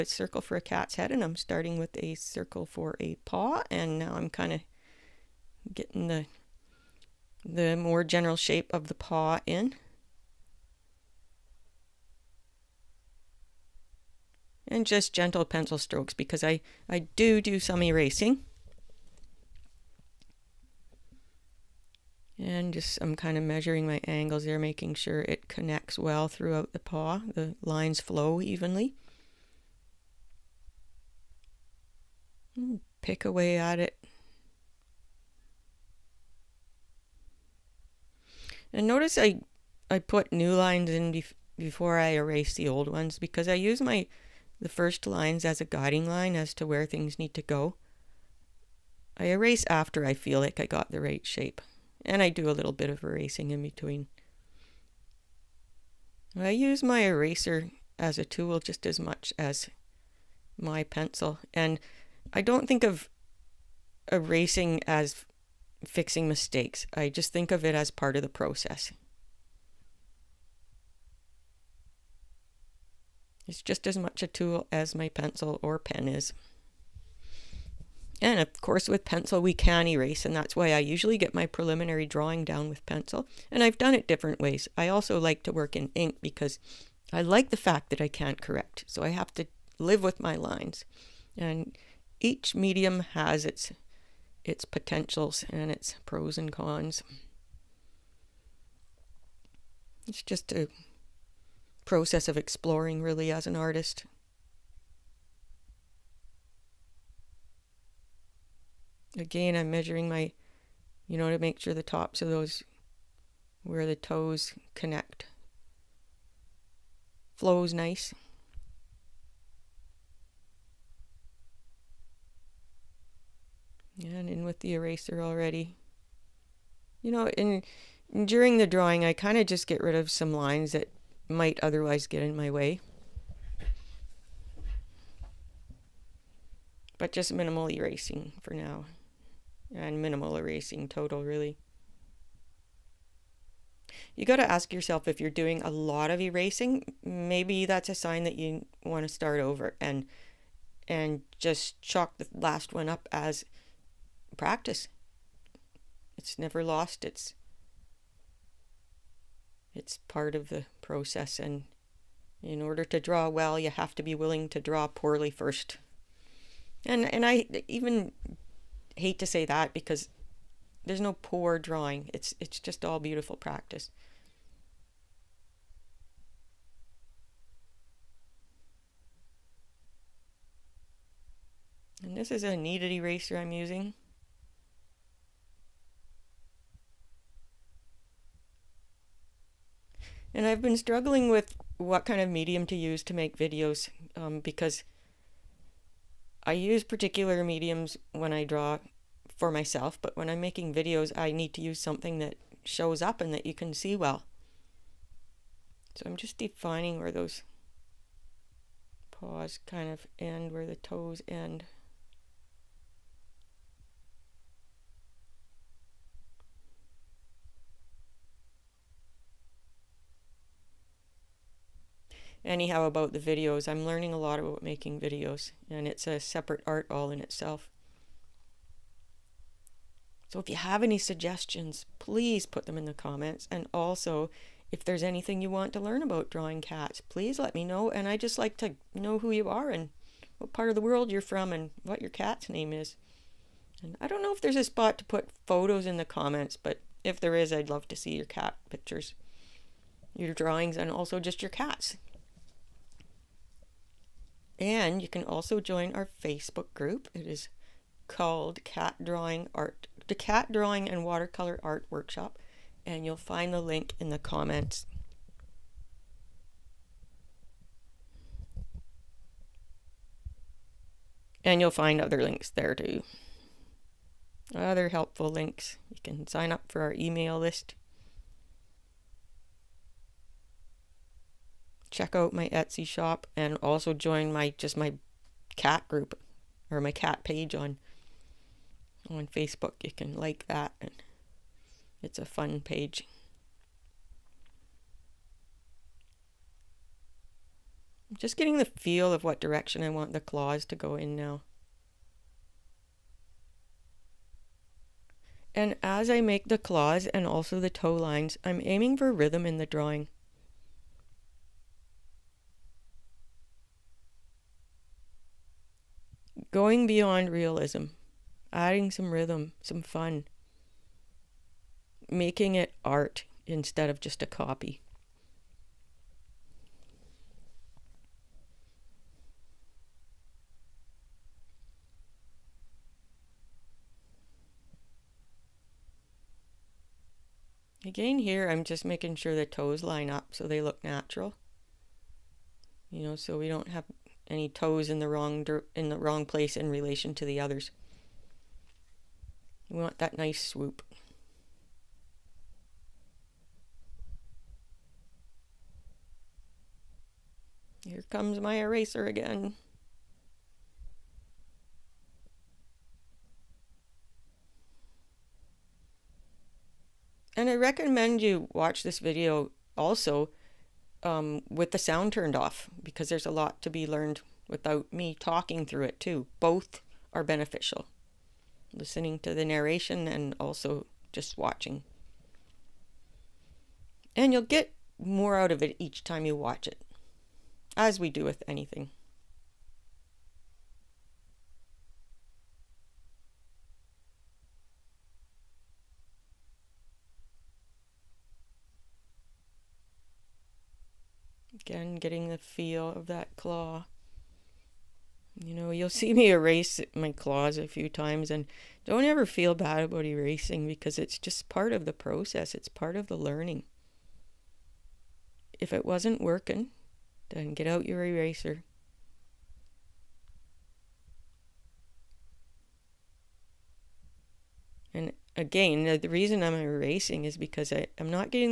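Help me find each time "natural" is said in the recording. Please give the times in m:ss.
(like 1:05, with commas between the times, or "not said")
5:40.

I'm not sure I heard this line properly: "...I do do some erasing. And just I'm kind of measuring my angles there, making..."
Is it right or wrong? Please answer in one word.
right.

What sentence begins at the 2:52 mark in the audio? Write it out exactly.
It's it's just all beautiful practice.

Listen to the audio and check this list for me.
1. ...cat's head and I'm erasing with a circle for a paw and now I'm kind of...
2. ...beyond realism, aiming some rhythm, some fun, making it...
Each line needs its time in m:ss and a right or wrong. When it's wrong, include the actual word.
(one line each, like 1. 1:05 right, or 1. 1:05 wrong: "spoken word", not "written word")
1. 0:00 wrong: "starting", not "erasing"
2. 5:16 wrong: "adding", not "aiming".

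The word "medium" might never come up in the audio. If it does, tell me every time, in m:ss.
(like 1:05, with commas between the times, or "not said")
1:32, 3:12, 3:17.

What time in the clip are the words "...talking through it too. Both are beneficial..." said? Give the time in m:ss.
6:15.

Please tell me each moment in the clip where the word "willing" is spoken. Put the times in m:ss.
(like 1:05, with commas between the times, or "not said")
2:44.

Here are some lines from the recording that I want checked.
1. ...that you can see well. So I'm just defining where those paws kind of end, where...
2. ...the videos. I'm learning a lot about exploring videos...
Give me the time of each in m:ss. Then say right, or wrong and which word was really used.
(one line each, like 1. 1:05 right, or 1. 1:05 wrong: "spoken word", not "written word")
1. 3:23 right
2. 3:43 wrong: "making", not "exploring".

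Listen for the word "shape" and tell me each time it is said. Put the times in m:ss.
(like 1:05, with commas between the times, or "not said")
0:08, 0:51.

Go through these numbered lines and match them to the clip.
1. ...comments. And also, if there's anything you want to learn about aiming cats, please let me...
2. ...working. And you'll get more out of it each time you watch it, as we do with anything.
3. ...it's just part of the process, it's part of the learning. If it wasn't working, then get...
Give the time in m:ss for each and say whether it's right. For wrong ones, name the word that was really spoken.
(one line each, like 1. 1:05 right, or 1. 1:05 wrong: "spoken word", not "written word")
1. 3:52 wrong: "drawing", not "aiming"
2. 6:21 wrong: "watching", not "working"
3. 6:50 right.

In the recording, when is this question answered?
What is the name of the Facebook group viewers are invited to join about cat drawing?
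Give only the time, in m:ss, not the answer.
4:18.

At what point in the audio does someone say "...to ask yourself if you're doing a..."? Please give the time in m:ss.
2:24.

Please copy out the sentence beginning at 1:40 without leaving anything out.
It's just a process of exploring really as an artist.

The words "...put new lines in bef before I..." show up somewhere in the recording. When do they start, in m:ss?
0:40.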